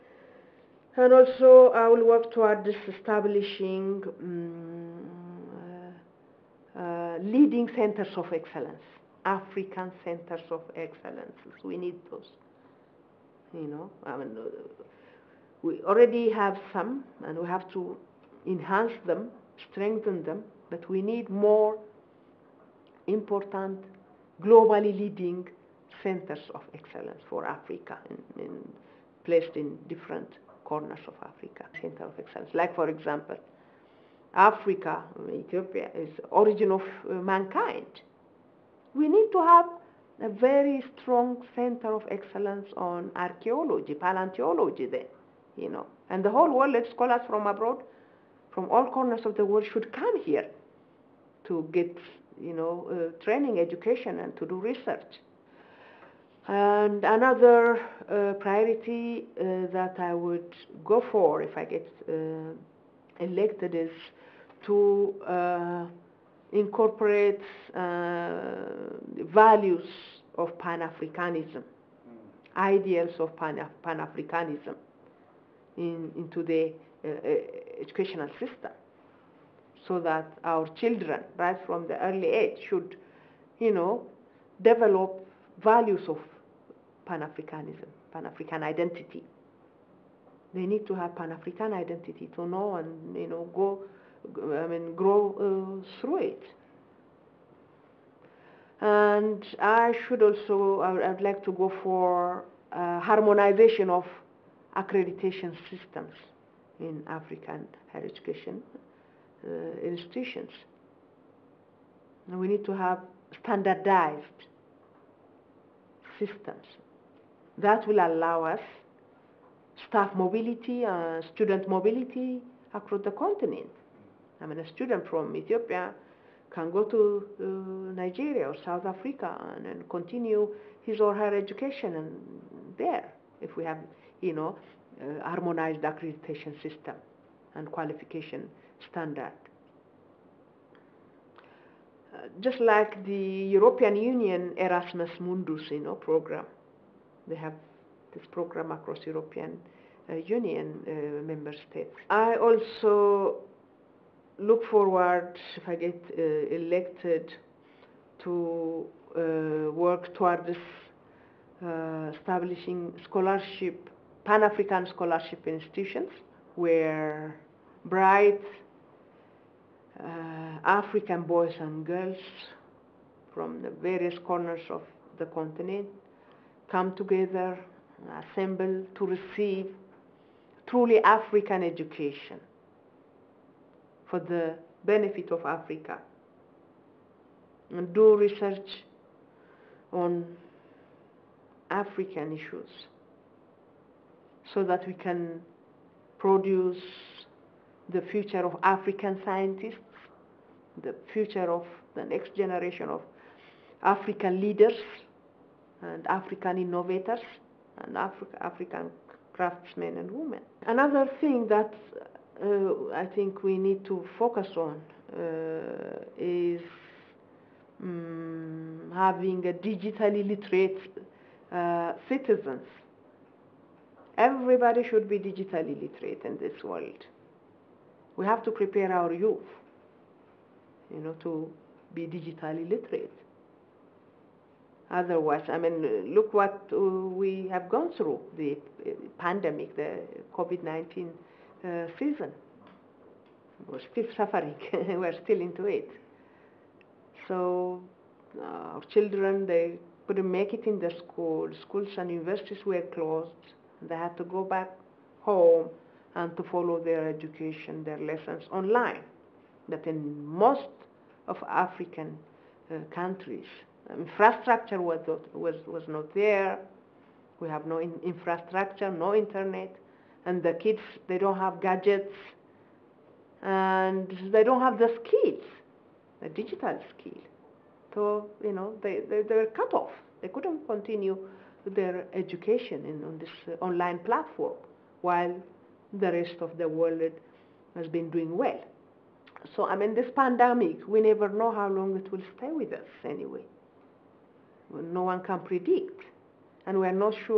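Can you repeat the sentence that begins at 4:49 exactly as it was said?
So, I mean, this pandemic, we never know how long it will stay with us anyway.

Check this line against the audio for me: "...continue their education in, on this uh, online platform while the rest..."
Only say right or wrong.
right.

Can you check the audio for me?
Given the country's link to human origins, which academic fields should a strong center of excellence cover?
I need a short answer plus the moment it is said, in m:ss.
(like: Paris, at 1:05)
Archaeology, paleontology, at 0:43.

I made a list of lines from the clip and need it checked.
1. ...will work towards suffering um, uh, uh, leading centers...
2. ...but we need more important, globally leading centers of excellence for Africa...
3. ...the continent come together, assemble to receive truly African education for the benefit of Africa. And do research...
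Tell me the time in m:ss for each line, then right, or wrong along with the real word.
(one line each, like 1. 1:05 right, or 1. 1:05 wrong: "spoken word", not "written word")
1. 0:01 wrong: "establishing", not "suffering"
2. 0:20 right
3. 2:55 right.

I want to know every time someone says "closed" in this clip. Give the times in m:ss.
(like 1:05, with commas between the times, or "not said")
4:12.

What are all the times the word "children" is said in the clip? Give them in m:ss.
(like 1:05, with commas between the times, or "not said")
1:20, 4:08.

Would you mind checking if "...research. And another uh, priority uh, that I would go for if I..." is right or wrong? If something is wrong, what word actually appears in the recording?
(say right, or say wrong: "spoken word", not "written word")
right.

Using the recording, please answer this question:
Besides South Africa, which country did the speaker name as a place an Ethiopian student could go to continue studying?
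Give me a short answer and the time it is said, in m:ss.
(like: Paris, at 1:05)
Nigeria, at 2:08.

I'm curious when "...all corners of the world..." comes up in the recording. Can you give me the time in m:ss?
0:48.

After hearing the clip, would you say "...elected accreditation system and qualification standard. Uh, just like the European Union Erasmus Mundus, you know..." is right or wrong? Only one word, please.
wrong.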